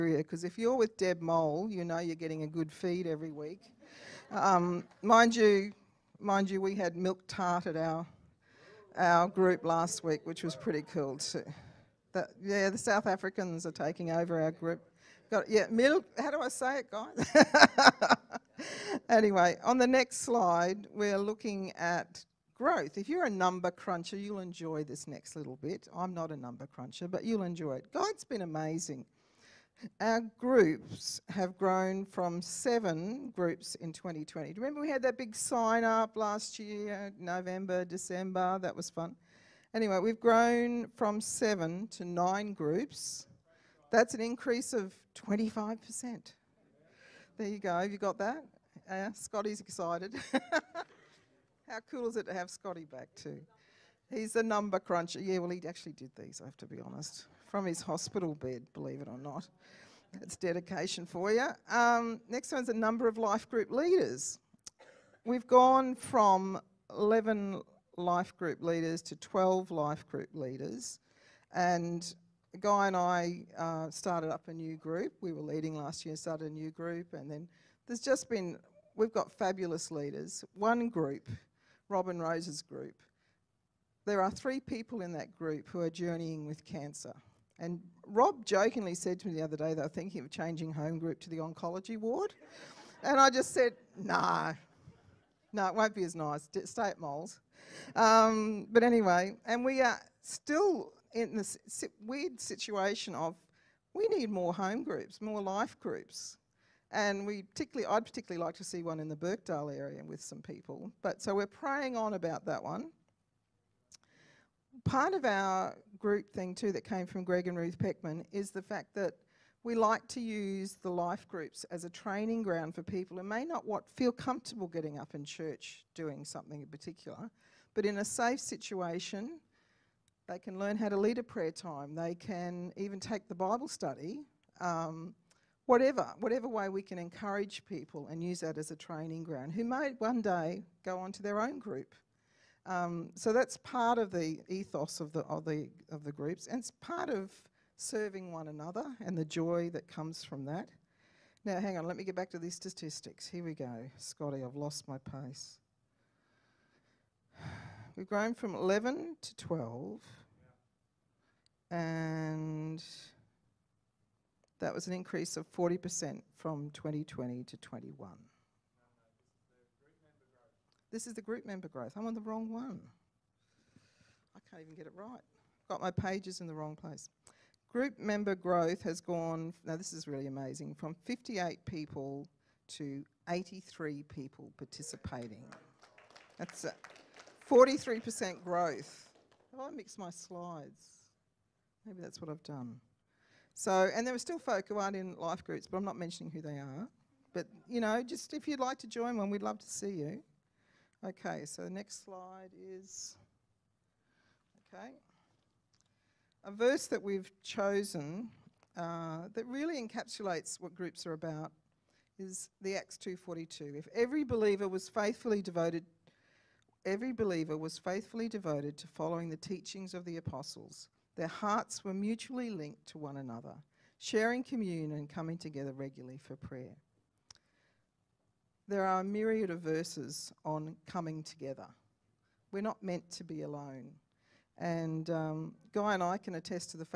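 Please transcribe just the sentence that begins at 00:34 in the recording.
Do Remember we had that big sign up last year, November, December, that was fun.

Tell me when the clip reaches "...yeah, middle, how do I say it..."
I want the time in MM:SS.
00:15.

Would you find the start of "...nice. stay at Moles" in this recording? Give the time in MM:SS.
01:36.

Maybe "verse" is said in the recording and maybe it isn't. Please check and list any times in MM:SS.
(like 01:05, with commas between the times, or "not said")
03:26, 03:49.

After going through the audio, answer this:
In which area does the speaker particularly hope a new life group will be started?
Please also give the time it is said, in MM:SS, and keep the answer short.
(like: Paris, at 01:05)
Birkdale, at 01:49.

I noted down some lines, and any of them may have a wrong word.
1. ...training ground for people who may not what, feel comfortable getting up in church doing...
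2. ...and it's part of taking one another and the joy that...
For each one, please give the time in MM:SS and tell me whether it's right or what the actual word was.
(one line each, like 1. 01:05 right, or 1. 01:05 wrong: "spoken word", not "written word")
1. 02:01 right
2. 02:26 wrong: "serving", not "taking".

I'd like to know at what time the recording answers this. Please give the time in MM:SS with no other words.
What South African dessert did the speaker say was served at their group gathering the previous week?
00:06.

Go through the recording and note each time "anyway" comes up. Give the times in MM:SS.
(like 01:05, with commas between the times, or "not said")
00:19, 00:39, 01:38.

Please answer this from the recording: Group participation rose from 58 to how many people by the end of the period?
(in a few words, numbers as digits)
83.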